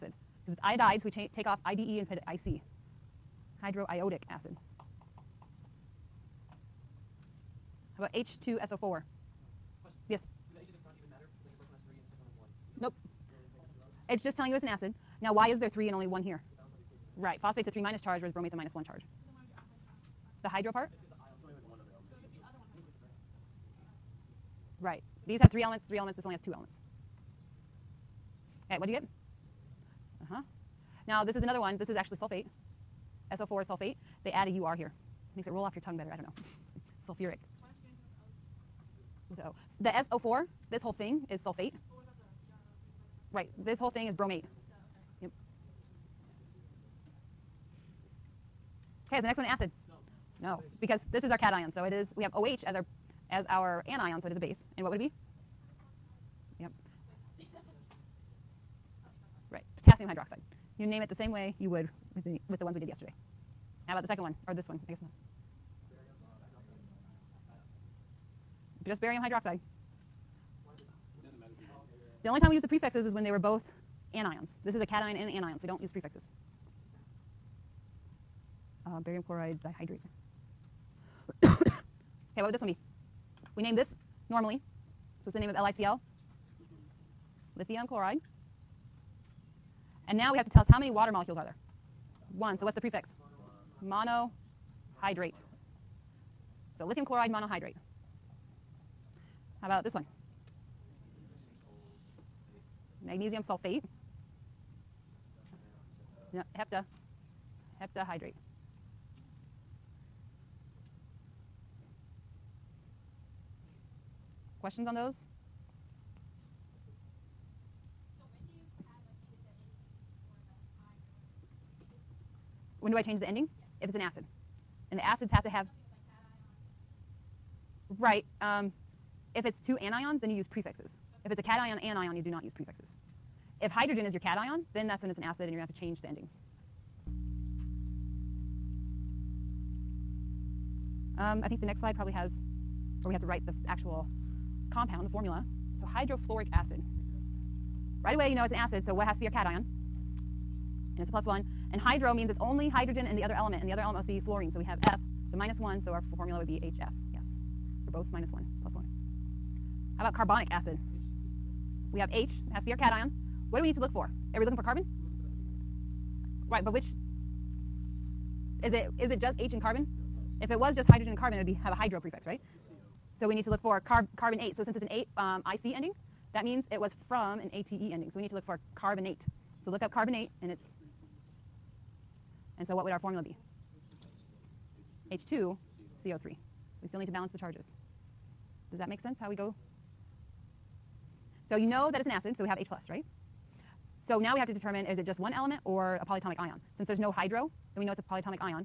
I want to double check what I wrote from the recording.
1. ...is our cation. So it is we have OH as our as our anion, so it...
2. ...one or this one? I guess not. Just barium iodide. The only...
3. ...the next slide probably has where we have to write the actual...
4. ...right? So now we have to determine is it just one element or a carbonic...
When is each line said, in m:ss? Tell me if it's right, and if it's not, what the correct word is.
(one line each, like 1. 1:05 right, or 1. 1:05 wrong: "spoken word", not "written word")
1. 0:51 right
2. 1:04 wrong: "hydroxide", not "iodide"
3. 2:21 right
4. 3:12 wrong: "polyatomic", not "carbonic".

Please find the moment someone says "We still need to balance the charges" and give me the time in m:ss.
3:06.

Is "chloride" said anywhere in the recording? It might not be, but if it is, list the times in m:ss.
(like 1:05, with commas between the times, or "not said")
1:19, 1:27, 1:37.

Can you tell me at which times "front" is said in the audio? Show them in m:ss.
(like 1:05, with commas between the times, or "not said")
0:10.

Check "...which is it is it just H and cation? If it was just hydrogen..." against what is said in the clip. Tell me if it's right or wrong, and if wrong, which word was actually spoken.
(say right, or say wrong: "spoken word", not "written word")
wrong: "carbon", not "cation".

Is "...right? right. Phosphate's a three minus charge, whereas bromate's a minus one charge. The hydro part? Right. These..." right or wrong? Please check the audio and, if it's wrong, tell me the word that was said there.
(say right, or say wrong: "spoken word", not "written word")
right.